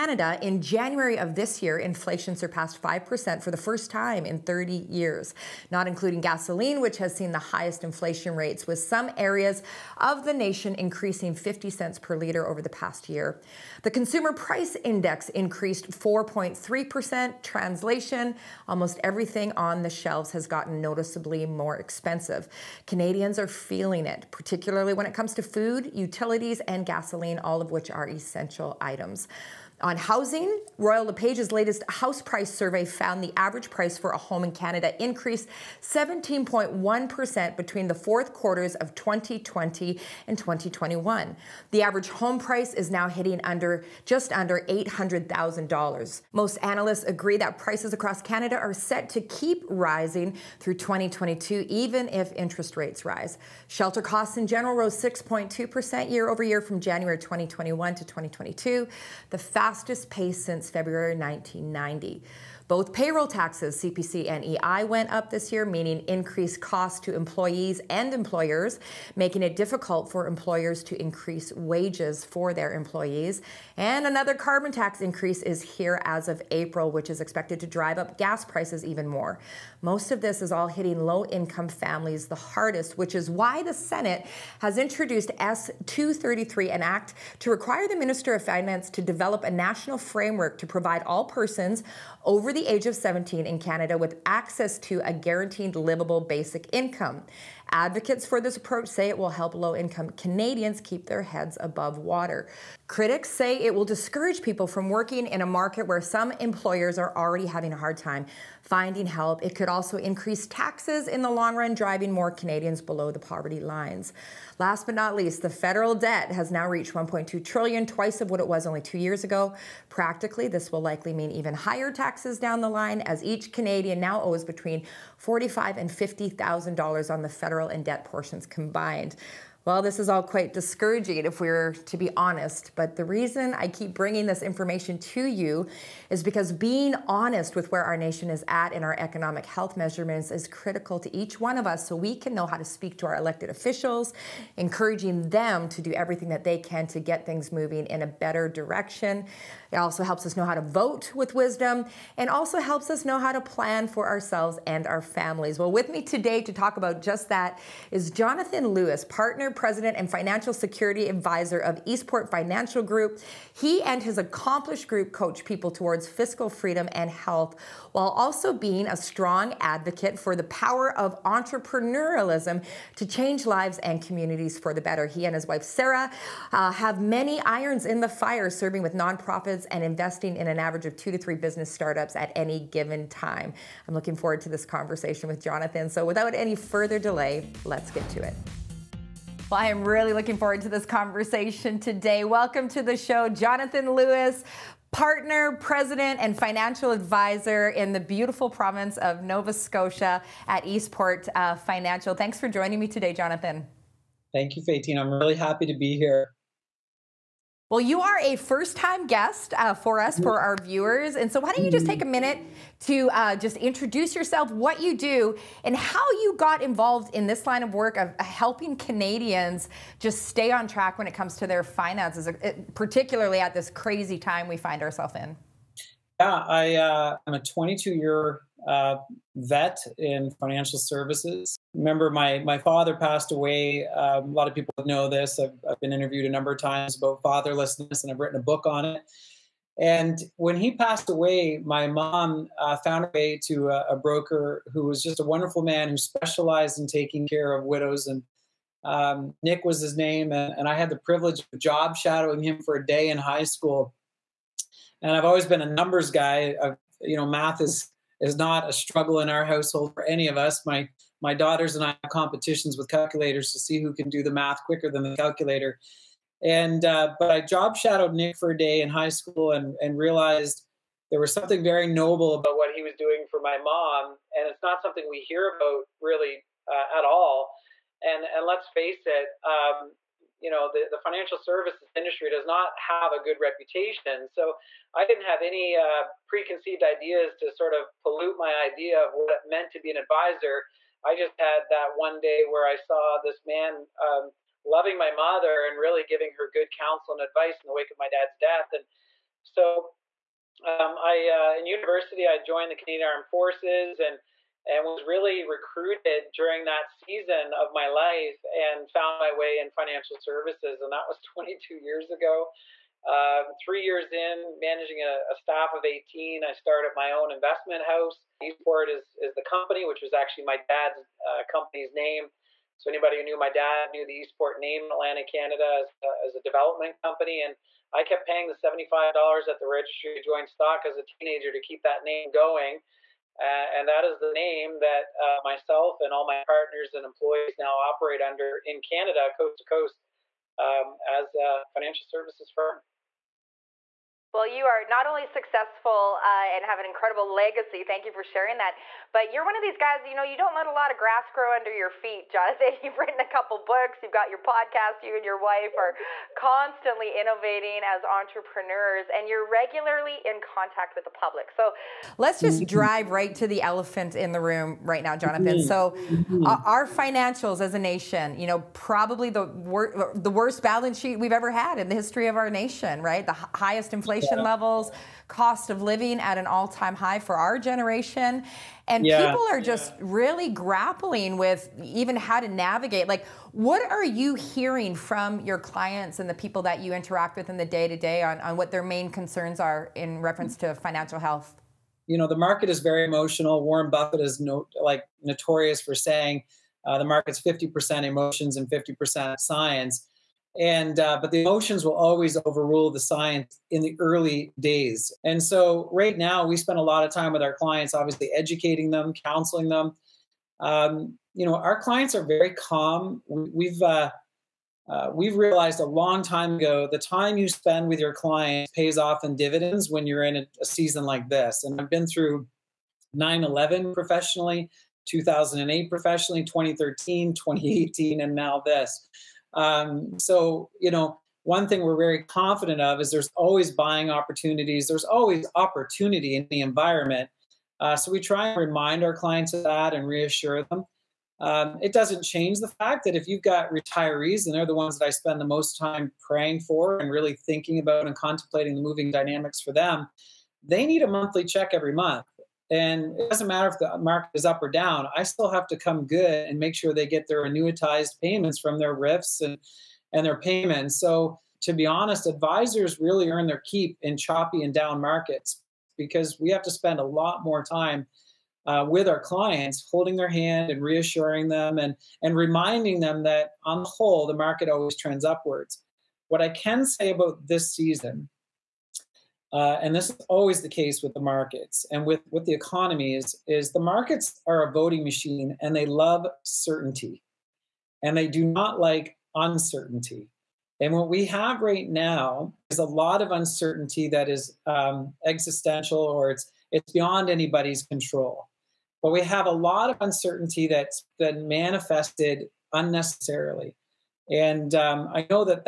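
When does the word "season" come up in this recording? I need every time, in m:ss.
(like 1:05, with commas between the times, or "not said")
5:06, 7:00, 7:57.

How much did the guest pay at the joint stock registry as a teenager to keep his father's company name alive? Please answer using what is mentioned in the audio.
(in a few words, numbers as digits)
$75.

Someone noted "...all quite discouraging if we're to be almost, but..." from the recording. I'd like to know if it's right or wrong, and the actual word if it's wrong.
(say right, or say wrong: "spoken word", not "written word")
wrong: "honest", not "almost".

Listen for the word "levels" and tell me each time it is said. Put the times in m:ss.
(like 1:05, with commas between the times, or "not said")
6:14.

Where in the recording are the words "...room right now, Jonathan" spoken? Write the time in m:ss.
6:04.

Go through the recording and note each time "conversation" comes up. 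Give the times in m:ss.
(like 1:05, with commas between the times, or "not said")
3:04, 3:10.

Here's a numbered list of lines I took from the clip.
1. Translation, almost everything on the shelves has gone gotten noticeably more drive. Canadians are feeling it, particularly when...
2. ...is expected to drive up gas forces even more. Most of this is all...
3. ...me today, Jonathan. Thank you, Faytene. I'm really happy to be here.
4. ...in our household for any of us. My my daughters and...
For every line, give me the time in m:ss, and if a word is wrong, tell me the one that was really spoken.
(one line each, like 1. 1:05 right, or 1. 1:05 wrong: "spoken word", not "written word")
1. 0:17 wrong: "expensive", not "drive"
2. 1:17 wrong: "prices", not "forces"
3. 3:22 right
4. 4:19 right.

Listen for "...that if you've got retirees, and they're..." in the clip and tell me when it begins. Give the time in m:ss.
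7:23.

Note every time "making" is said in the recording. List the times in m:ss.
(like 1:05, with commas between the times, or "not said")
1:09.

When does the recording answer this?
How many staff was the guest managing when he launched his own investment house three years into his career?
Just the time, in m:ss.
5:15.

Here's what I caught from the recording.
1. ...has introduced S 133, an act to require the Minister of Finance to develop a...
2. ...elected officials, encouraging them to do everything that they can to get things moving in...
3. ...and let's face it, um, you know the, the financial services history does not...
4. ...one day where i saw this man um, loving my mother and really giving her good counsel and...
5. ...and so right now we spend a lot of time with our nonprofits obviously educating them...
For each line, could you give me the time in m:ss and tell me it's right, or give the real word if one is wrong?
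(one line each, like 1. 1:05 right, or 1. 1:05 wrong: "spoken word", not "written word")
1. 1:24 wrong: "233", not "133"
2. 2:23 right
3. 4:38 wrong: "industry", not "history"
4. 4:51 right
5. 6:45 wrong: "clients", not "nonprofits".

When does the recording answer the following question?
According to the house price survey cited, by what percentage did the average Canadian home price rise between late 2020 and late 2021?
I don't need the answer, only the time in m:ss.
0:35.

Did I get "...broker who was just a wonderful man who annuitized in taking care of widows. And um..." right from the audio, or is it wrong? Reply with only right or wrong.
wrong.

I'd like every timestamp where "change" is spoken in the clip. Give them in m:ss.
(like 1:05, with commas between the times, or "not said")
2:53, 7:22.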